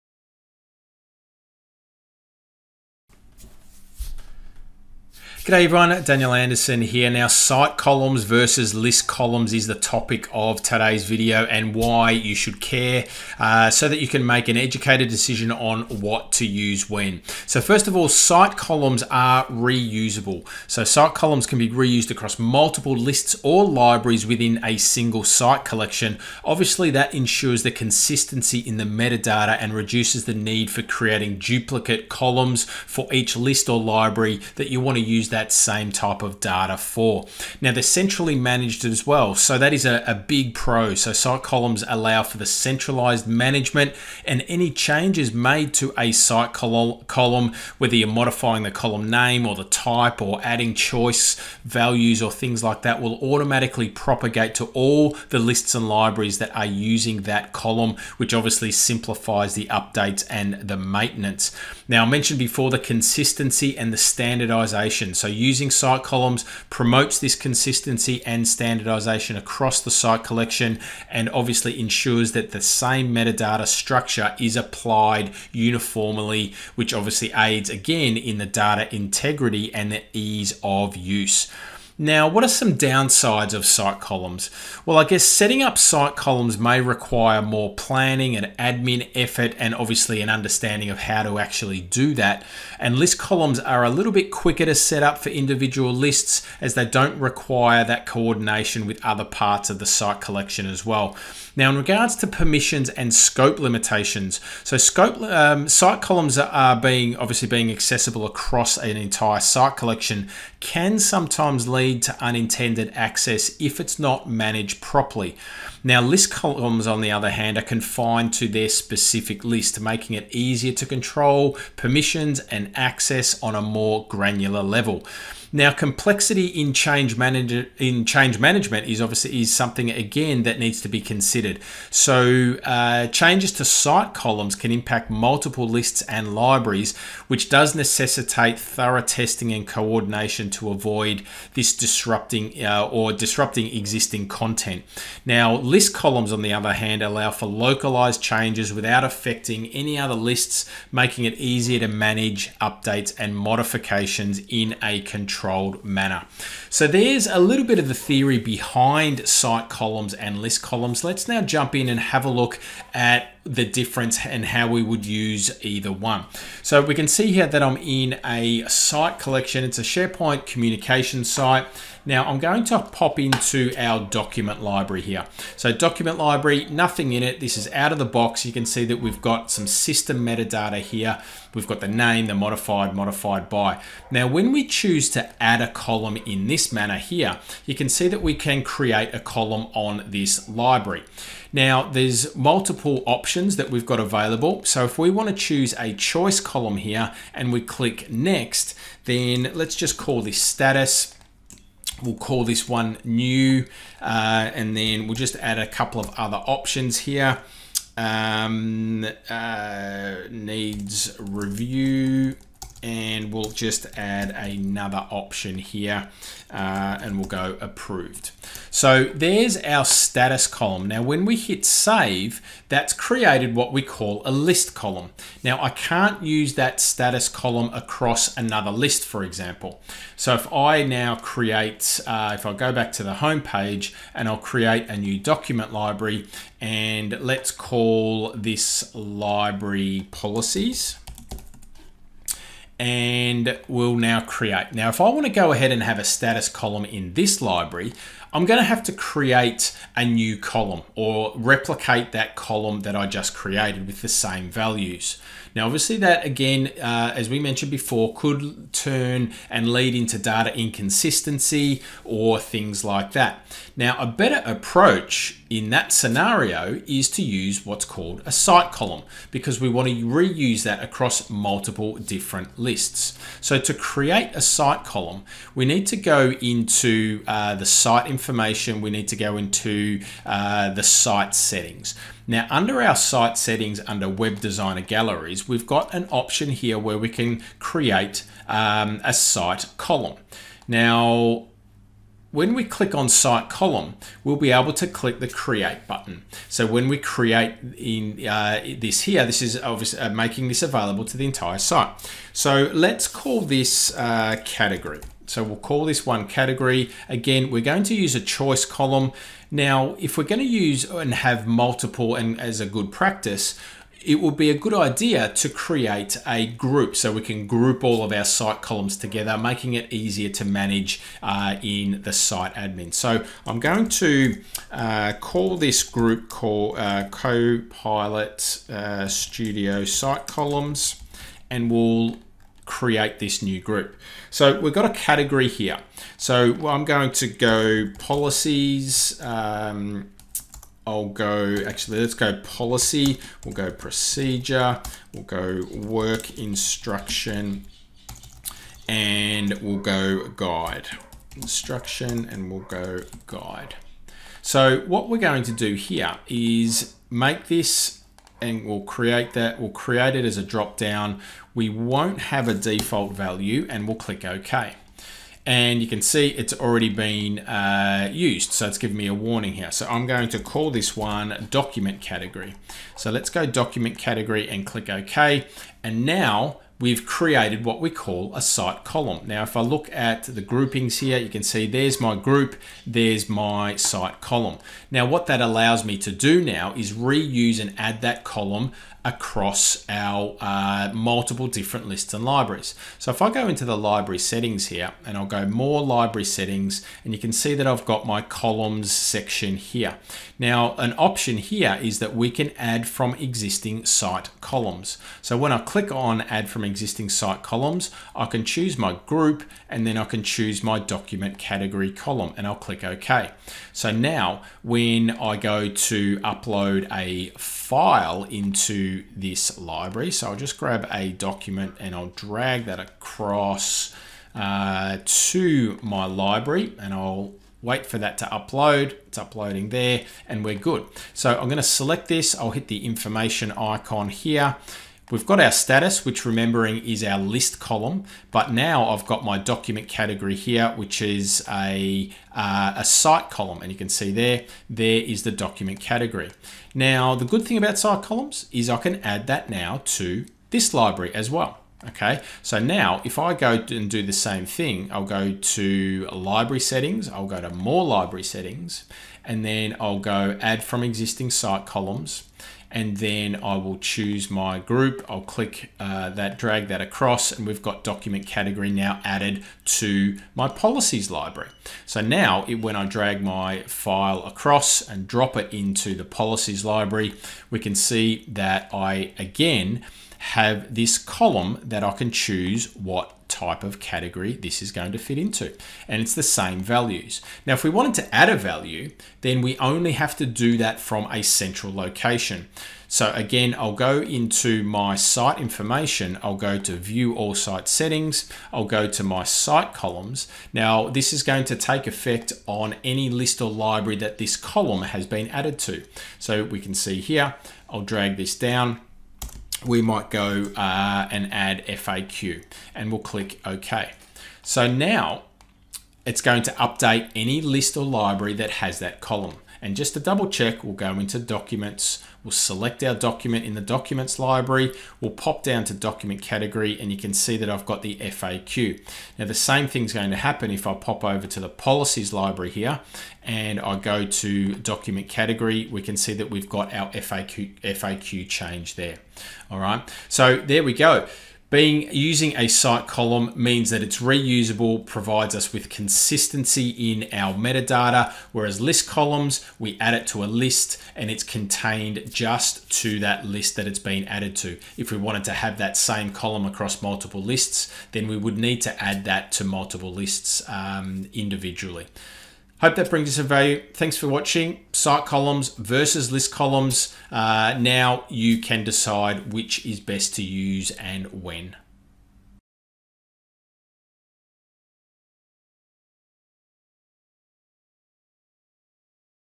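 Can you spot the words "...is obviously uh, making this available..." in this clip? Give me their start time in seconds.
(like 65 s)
299 s.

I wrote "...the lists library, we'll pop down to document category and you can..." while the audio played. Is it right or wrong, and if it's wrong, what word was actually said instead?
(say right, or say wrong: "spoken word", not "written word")
wrong: "documents", not "lists".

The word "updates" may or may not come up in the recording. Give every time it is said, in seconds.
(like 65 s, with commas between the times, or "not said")
59 s, 152 s, 516 s.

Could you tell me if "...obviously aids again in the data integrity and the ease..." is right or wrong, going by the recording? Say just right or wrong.
right.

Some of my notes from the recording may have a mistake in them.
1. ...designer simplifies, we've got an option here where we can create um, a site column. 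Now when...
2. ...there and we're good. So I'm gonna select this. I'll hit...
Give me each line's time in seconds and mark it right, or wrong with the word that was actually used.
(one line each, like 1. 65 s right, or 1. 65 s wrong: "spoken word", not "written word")
1. 284 s wrong: "galleries", not "simplifies"
2. 429 s right.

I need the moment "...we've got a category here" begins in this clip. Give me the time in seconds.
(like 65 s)
334 s.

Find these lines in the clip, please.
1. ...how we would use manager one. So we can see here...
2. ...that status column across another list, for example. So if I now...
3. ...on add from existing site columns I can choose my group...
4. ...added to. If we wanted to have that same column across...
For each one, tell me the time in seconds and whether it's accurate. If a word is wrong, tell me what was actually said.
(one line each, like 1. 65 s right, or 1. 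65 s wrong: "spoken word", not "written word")
1. 164 s wrong: "either", not "manager"
2. 226 s right
3. 405 s right
4. 554 s right.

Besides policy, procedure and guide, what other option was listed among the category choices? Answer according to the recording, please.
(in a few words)
work instruction.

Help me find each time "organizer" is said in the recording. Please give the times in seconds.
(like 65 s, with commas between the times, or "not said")
not said.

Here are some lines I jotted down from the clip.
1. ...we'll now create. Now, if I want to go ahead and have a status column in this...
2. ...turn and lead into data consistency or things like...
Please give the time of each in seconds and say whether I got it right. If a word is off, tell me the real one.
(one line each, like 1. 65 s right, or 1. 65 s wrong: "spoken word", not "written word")
1. 243 s right
2. 258 s wrong: "inconsistency", not "consistency".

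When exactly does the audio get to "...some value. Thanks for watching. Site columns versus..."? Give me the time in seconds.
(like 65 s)
563 s.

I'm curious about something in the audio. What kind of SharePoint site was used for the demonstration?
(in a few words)
communication site.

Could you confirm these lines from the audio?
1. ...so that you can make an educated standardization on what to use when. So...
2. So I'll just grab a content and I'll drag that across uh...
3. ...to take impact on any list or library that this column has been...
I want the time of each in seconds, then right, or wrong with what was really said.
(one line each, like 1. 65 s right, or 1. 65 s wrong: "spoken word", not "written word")
1. 13 s wrong: "decision", not "standardization"
2. 420 s wrong: "document", not "content"
3. 501 s wrong: "effect", not "impact".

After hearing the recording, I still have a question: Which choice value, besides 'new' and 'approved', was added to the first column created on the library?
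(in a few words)
needs review.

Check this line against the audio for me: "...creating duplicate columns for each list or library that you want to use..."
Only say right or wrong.
right.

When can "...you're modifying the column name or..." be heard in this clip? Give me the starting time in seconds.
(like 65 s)
47 s.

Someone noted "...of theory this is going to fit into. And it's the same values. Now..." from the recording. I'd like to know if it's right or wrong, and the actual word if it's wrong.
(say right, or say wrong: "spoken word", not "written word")
wrong: "category", not "theory".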